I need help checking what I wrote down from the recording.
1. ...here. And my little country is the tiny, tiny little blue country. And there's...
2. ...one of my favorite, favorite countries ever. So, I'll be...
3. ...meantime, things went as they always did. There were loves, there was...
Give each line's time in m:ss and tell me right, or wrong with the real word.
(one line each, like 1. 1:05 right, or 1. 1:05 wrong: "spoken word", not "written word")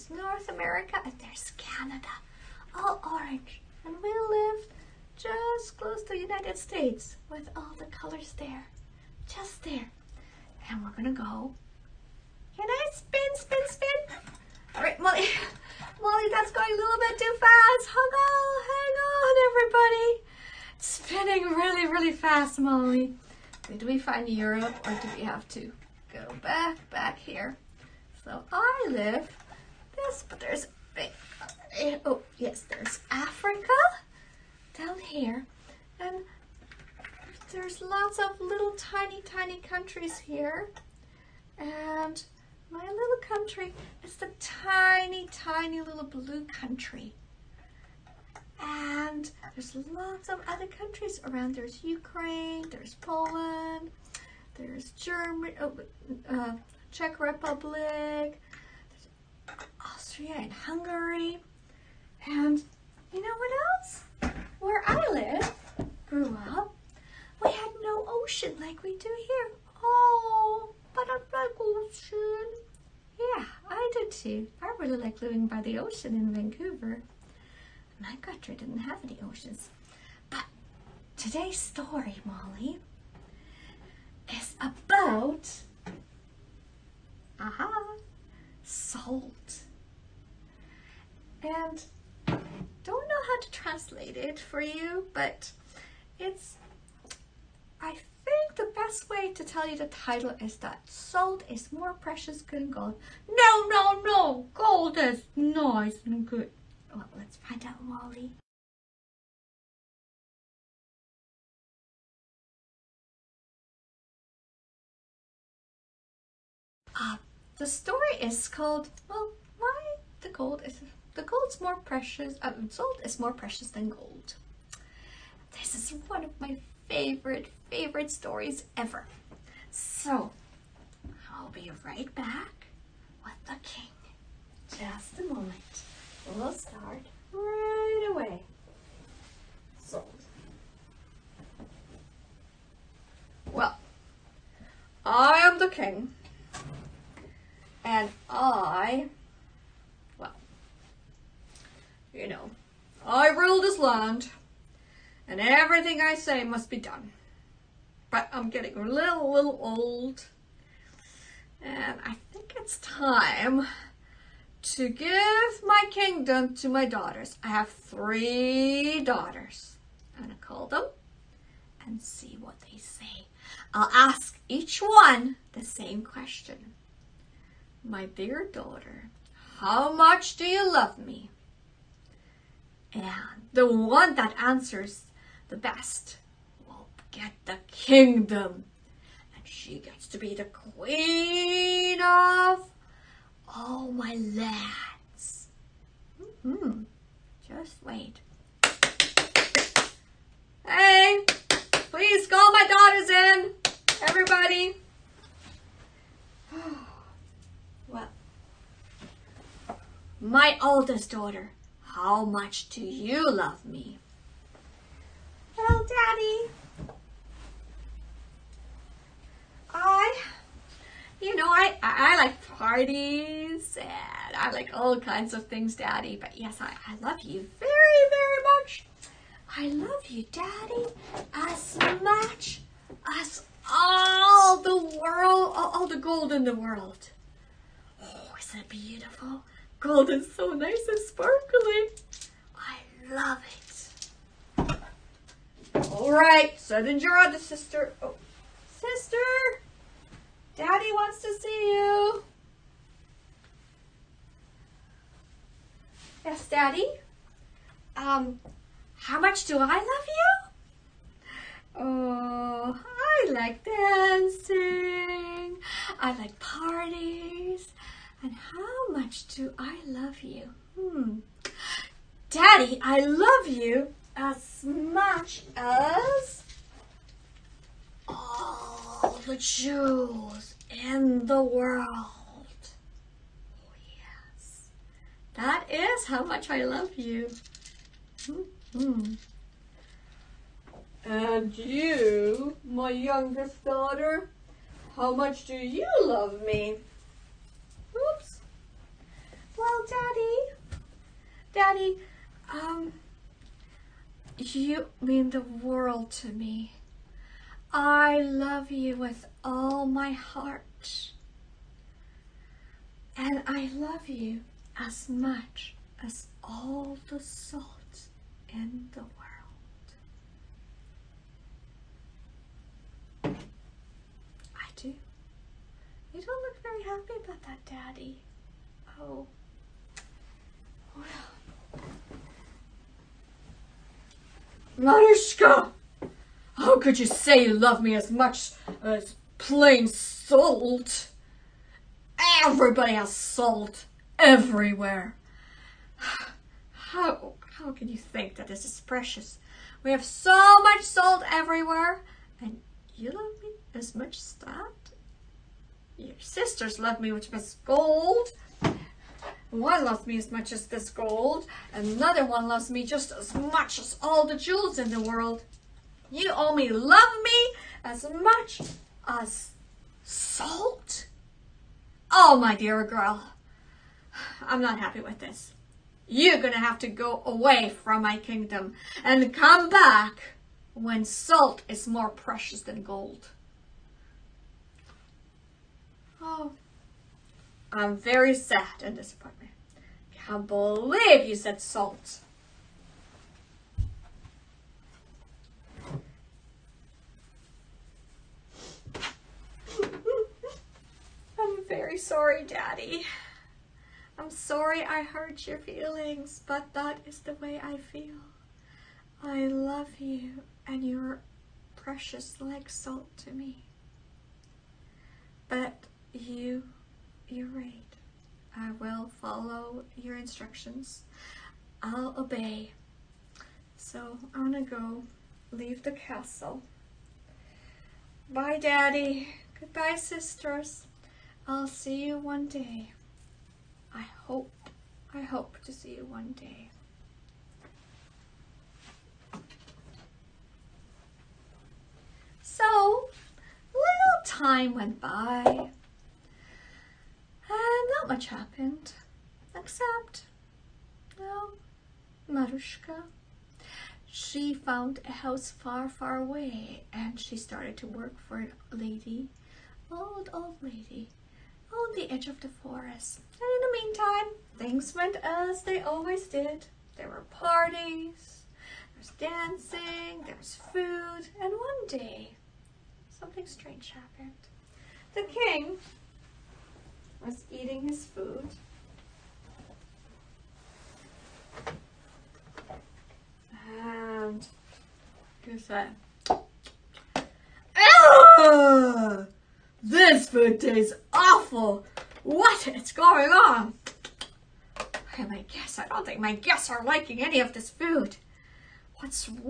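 1. 0:40 right
2. 2:06 wrong: "stories", not "countries"
3. 7:43 wrong: "parties", not "loves".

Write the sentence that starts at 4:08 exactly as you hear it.
Oh, sister, daddy wants to see you.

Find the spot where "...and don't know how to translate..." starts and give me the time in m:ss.
1:31.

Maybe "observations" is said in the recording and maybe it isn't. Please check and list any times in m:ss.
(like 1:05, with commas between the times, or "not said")
not said.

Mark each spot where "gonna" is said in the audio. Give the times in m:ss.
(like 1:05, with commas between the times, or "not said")
0:10, 2:50, 7:04.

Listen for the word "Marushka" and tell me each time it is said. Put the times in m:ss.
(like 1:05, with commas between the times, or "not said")
5:34, 7:32.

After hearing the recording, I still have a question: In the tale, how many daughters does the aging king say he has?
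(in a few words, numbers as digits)
3.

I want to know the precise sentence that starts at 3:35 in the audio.
little Daddy, I, you know, I, I like parties and I like all kinds of things, Daddy.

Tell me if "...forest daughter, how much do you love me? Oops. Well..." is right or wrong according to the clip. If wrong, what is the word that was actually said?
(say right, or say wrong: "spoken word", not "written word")
wrong: "youngest", not "forest".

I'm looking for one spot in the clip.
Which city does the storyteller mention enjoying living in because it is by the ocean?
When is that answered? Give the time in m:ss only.
1:16.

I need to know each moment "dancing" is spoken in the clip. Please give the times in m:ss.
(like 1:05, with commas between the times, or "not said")
4:23, 7:49.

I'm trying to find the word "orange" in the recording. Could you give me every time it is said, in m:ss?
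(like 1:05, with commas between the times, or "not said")
0:03.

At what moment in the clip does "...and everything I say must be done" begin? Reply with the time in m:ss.
2:35.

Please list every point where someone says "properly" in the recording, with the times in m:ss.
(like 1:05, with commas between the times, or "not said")
not said.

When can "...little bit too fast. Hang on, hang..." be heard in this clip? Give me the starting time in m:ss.
0:16.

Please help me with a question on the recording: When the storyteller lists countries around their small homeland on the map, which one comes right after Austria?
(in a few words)
Hungary.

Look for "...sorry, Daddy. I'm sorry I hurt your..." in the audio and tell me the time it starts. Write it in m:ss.
6:41.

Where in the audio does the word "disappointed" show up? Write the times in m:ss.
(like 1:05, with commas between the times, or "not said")
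6:28.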